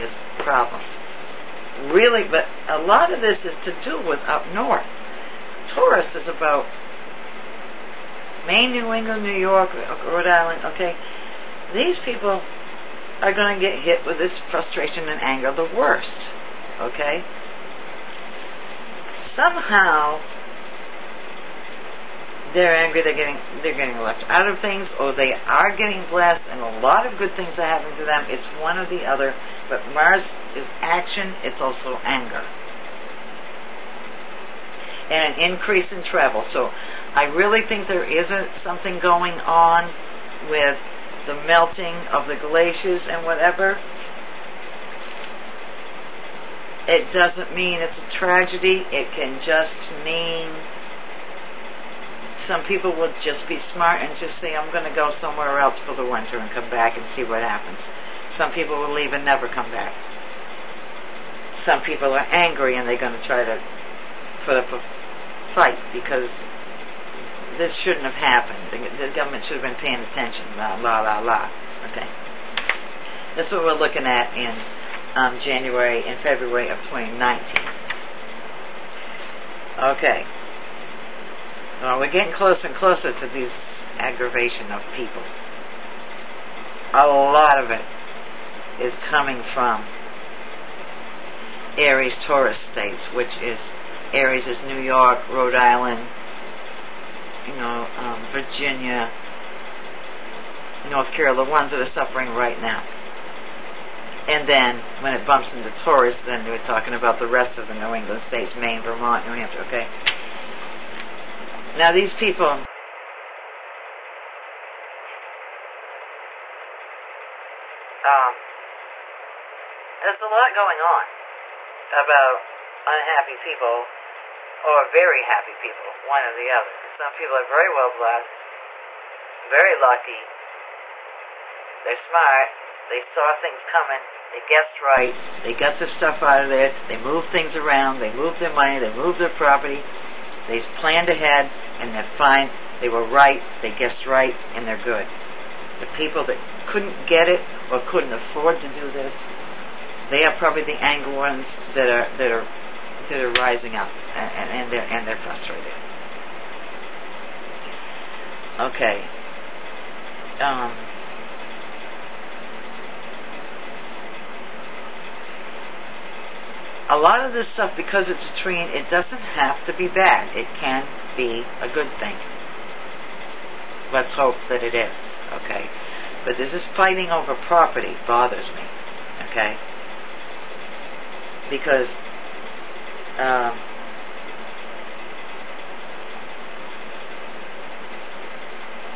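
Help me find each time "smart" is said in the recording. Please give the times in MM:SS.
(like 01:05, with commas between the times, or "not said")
00:53, 02:12.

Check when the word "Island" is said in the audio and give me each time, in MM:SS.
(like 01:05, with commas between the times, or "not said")
00:10, 01:35.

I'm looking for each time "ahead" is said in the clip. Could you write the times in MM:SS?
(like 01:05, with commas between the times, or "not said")
02:21.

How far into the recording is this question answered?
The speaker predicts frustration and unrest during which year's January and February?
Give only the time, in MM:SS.
01:16.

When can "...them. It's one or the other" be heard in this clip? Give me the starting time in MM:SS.
00:28.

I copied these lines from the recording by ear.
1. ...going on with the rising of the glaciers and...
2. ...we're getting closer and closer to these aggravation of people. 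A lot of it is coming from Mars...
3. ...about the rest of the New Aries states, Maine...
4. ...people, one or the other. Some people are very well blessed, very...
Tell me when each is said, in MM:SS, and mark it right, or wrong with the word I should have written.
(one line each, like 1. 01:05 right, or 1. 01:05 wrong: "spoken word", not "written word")
1. 00:39 wrong: "melting", not "rising"
2. 01:21 wrong: "Aries", not "Mars"
3. 01:46 wrong: "England", not "Aries"
4. 02:05 right.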